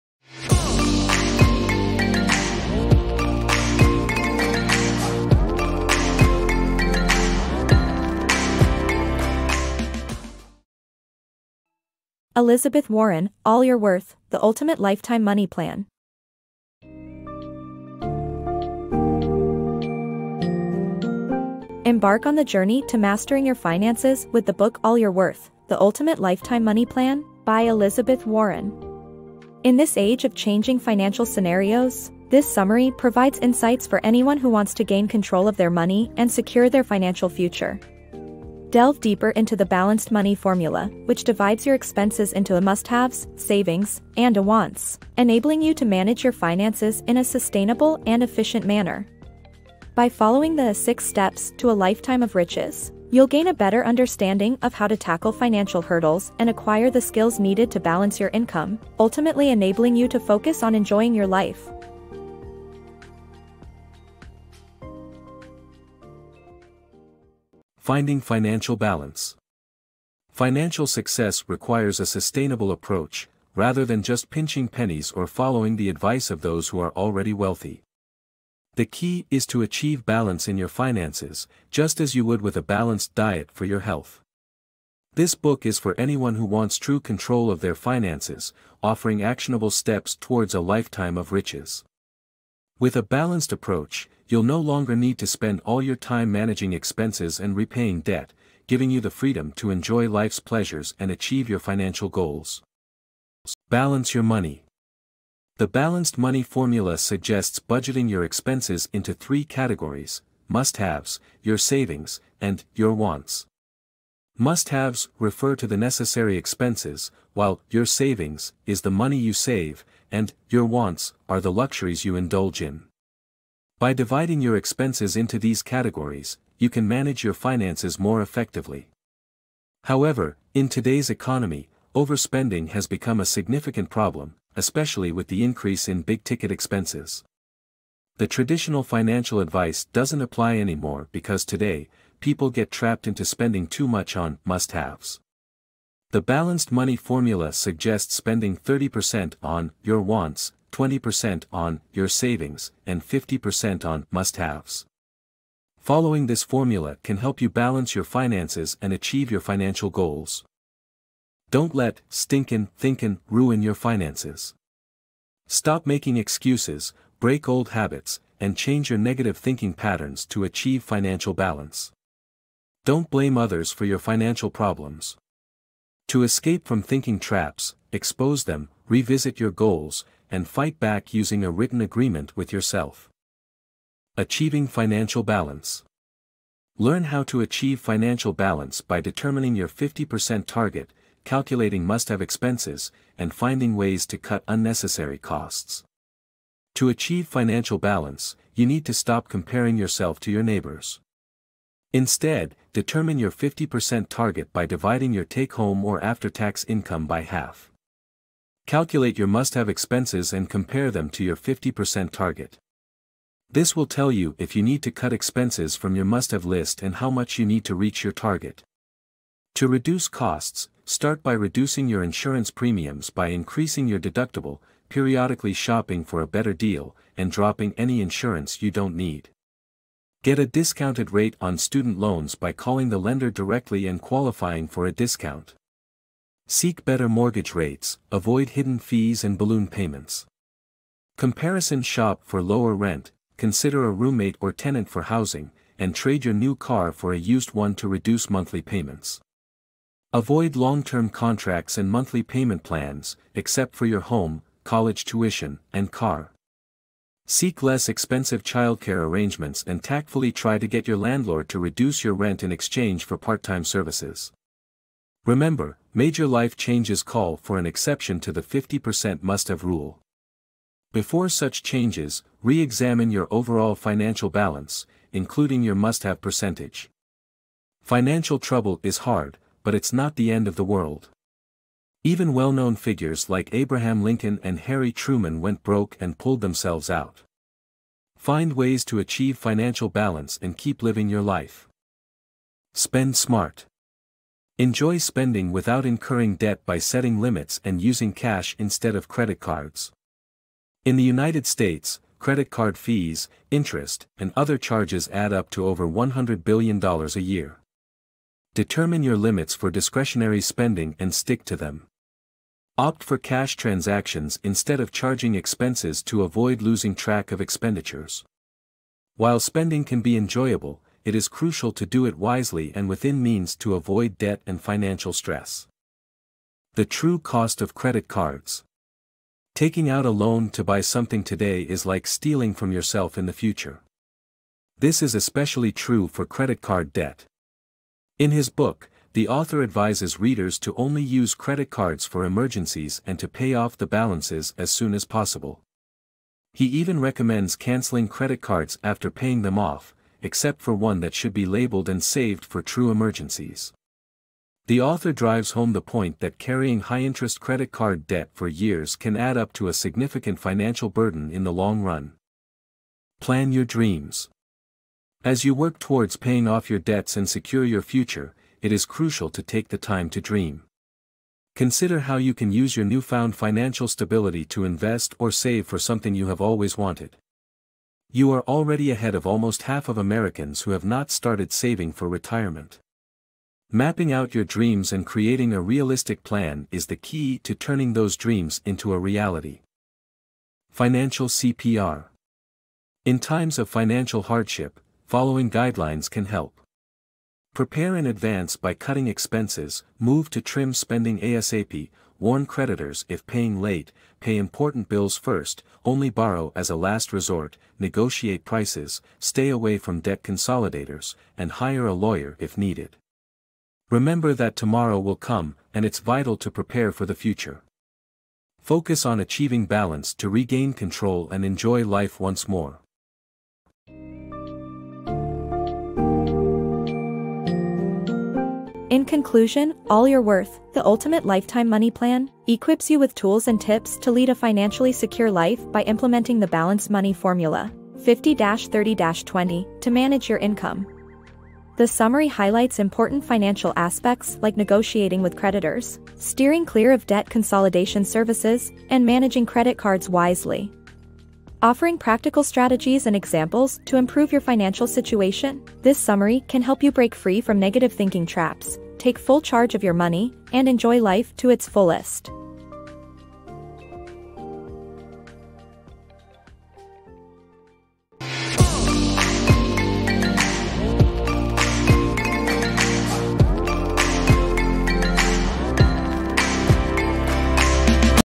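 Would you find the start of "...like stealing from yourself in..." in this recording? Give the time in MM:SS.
05:31.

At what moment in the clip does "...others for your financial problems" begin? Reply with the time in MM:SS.
02:53.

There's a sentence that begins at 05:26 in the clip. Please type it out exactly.
The true cost of credit cards.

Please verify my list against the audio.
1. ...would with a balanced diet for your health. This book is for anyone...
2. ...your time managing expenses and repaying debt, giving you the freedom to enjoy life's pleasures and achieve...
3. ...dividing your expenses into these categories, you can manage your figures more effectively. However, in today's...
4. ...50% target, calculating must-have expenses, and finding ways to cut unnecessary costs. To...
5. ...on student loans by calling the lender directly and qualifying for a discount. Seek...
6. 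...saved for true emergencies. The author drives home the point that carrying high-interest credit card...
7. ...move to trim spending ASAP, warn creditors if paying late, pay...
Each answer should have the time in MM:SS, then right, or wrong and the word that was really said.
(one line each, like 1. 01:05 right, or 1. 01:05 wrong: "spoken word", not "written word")
1. 01:22 right
2. 01:35 right
3. 02:03 wrong: "finances", not "figures"
4. 03:09 right
5. 03:51 right
6. 05:52 right
7. 06:39 right.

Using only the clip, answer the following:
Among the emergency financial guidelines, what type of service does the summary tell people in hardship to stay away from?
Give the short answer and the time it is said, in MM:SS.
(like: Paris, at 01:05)
debt consolidators, at 06:49.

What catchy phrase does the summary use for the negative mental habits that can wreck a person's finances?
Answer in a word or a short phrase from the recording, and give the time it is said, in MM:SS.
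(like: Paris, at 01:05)
stinkin' thinkin', at 02:42.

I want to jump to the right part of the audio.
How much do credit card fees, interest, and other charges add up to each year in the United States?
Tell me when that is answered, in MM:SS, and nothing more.
05:05.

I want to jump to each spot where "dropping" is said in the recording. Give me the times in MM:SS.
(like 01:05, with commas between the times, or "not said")
03:47.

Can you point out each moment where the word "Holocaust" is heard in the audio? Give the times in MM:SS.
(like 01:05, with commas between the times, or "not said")
not said.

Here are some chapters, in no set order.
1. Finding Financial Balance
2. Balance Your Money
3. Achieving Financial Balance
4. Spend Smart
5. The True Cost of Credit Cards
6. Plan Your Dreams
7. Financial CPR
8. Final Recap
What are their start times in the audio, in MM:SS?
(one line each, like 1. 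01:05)
1. 01:08
2. 01:44
3. 03:04
4. 04:53
5. 05:27
6. 06:03
7. 06:31
8. 07:04.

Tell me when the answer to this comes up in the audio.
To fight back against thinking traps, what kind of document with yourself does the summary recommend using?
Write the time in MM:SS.
03:01.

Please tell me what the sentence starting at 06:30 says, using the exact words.
Financial CPR In times of financial hardship, following guidelines can help.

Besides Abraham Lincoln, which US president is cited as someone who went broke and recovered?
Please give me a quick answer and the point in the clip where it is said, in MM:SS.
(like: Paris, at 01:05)
Harry Truman, at 04:44.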